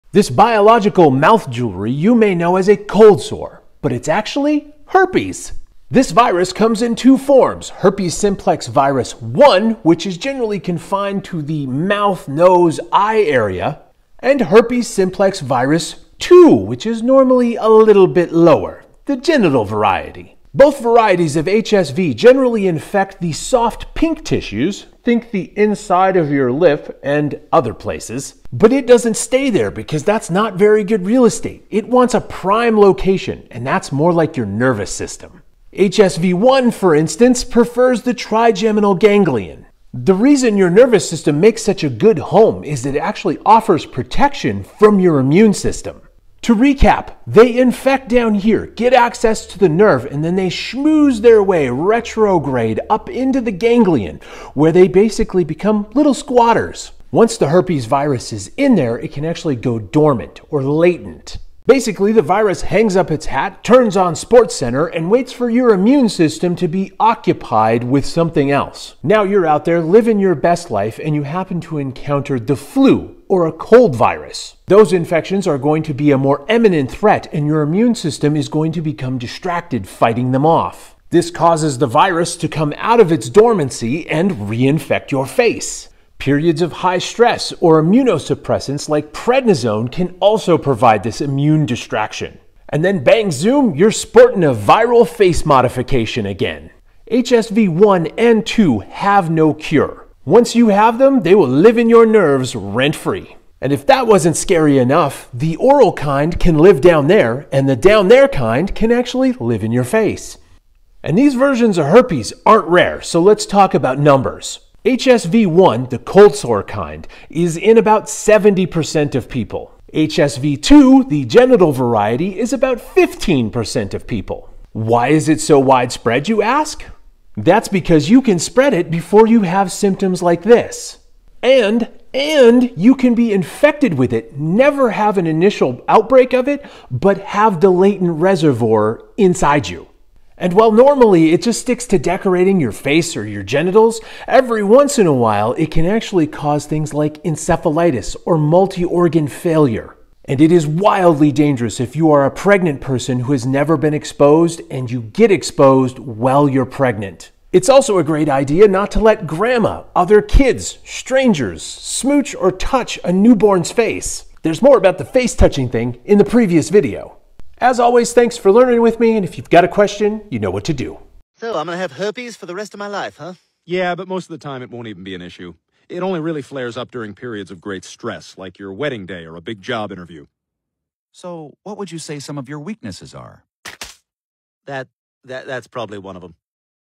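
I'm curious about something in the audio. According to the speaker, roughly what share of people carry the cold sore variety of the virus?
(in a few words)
70%.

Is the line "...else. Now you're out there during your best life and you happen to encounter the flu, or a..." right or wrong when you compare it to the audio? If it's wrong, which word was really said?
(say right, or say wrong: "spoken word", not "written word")
wrong: "living", not "during".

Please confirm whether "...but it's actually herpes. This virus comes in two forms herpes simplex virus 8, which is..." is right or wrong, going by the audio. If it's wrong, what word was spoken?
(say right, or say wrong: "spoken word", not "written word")
wrong: "1", not "8".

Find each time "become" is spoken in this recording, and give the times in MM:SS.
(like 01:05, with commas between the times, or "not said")
00:55, 01:18.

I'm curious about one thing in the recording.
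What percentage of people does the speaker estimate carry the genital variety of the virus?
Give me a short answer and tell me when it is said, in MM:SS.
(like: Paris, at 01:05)
15%, at 02:02.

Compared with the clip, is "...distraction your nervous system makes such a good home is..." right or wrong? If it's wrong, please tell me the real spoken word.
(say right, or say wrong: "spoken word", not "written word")
wrong: "reason", not "distraction".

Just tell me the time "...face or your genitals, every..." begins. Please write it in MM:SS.
02:22.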